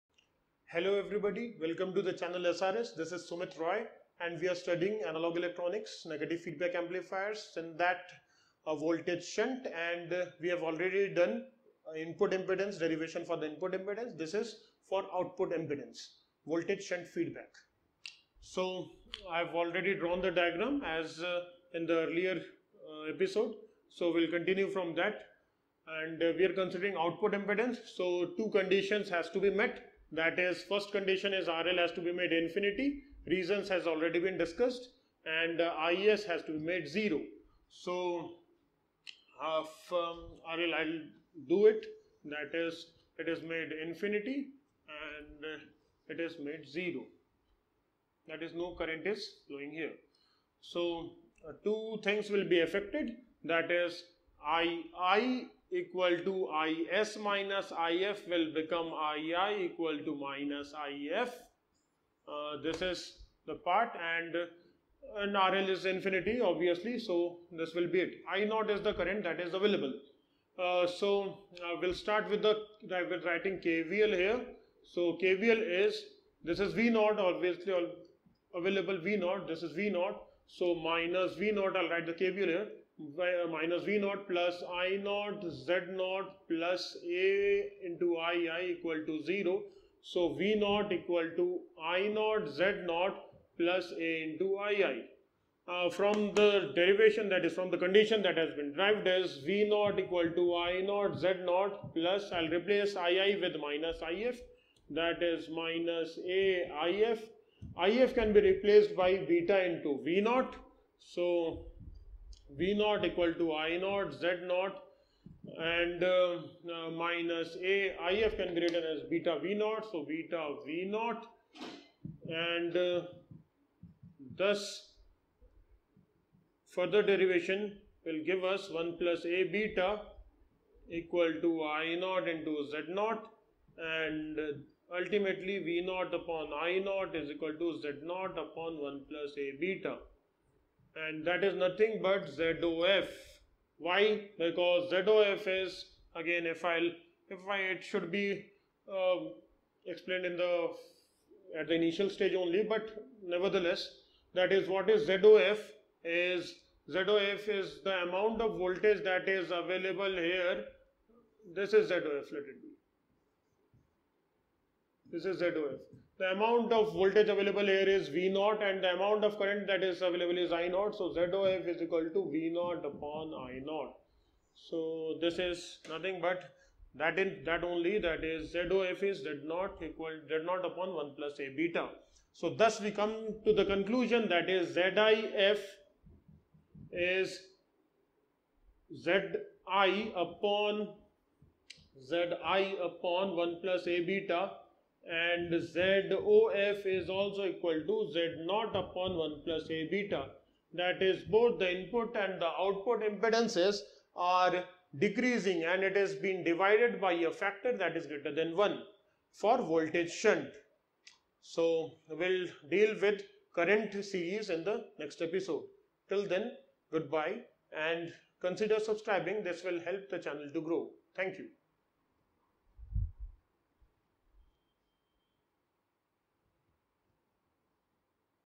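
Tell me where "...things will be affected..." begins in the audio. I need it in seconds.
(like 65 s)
52 s.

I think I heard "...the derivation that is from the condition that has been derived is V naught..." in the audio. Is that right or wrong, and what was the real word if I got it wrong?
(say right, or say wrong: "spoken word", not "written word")
right.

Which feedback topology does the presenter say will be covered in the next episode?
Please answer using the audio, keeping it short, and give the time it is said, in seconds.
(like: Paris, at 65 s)
current series, at 213 s.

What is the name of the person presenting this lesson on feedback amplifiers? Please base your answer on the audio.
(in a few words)
Sumit Roy.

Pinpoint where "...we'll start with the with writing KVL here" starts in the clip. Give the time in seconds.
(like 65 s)
71 s.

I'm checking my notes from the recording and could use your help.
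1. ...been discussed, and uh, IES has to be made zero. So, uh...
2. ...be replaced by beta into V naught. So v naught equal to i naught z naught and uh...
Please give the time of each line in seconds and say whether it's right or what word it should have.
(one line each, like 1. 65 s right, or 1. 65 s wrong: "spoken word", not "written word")
1. 34 s right
2. 108 s right.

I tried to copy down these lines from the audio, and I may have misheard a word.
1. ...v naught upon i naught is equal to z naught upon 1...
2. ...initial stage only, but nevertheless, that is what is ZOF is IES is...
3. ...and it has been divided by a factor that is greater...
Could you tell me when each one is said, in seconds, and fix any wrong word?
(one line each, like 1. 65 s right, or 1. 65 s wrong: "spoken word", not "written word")
1. 135 s right
2. 151 s wrong: "ZOF", not "IES"
3. 205 s right.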